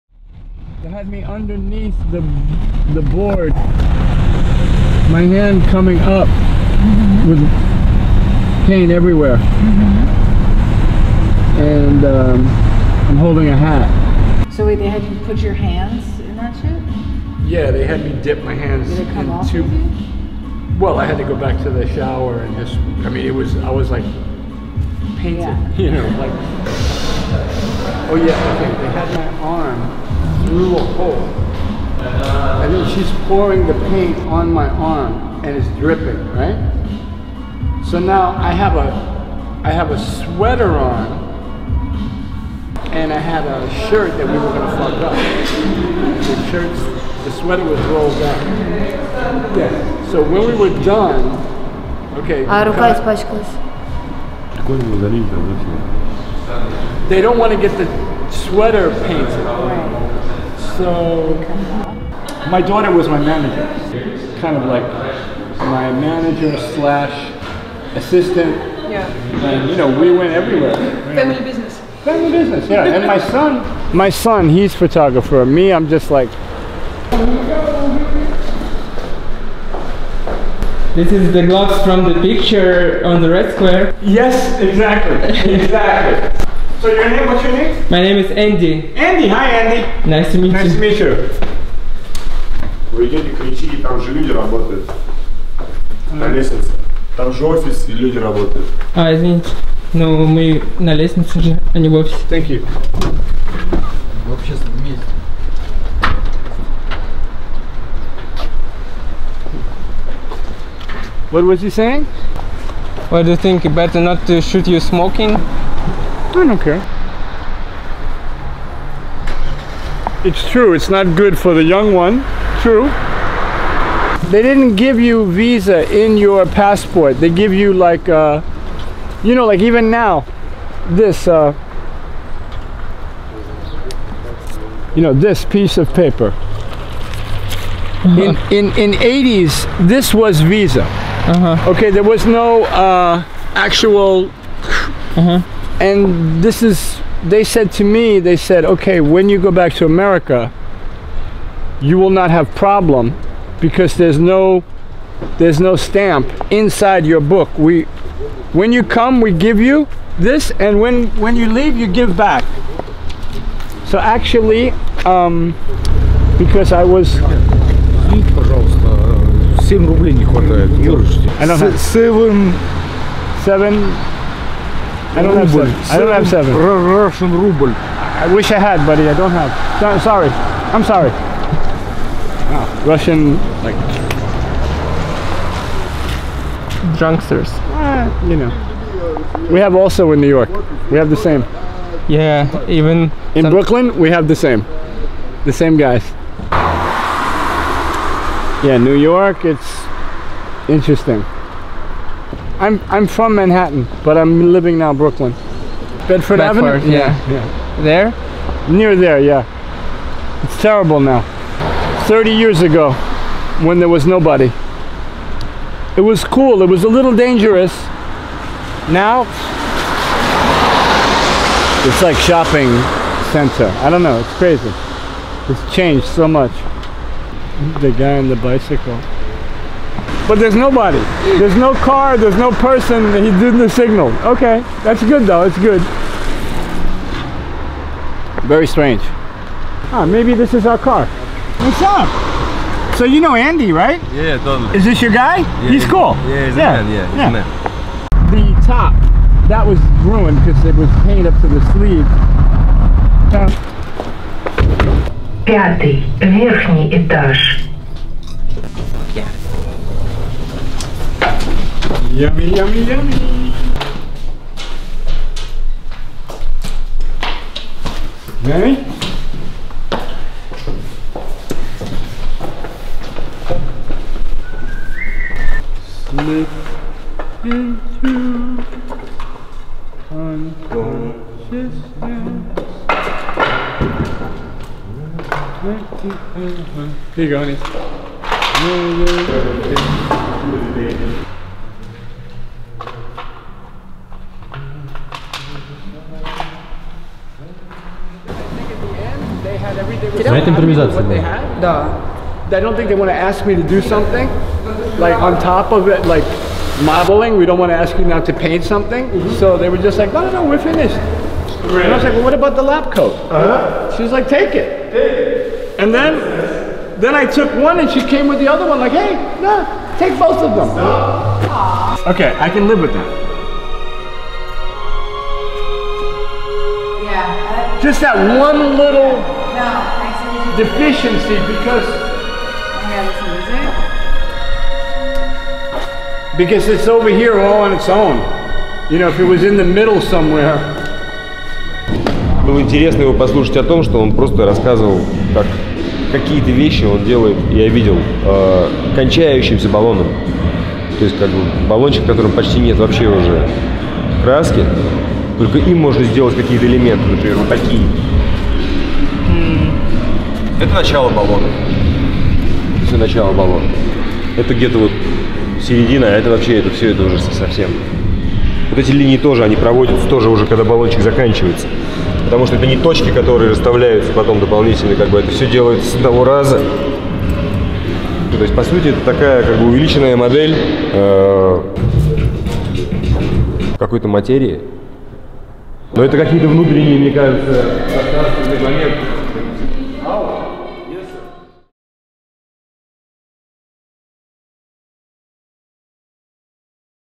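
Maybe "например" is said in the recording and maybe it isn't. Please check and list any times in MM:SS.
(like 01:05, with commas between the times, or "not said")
05:57.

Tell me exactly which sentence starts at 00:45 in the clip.
The shirts, the sweater was rolled up.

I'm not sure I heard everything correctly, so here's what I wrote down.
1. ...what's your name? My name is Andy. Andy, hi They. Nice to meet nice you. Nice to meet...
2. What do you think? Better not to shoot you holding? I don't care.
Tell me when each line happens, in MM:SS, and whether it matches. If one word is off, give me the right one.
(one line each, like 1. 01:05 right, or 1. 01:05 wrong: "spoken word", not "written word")
1. 01:27 wrong: "Andy", not "They"
2. 01:53 wrong: "smoking", not "holding".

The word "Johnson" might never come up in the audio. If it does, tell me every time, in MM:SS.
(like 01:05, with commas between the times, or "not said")
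not said.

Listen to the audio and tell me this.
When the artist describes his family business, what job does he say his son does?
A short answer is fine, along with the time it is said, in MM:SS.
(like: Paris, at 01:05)
photographer, at 01:14.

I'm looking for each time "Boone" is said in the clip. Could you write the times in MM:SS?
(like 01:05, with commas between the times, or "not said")
not said.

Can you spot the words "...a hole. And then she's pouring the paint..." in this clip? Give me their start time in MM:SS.
00:30.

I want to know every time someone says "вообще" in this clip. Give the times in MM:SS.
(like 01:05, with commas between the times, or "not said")
05:52, 06:06.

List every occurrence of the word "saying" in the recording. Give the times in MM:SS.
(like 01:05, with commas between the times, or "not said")
01:51.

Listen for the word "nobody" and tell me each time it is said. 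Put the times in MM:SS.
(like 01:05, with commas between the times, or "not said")
03:34, 03:50.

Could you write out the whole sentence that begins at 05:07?
We don't want to ask you now to paint something.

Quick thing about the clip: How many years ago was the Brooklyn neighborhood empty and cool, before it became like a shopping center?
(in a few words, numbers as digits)
30.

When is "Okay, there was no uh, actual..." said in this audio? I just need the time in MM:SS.
02:21.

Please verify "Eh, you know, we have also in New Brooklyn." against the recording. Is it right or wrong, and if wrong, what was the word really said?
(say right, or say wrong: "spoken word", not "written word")
wrong: "York", not "Brooklyn".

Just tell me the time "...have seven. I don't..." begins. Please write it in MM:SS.
02:55.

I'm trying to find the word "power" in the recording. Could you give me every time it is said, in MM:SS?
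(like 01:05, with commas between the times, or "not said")
not said.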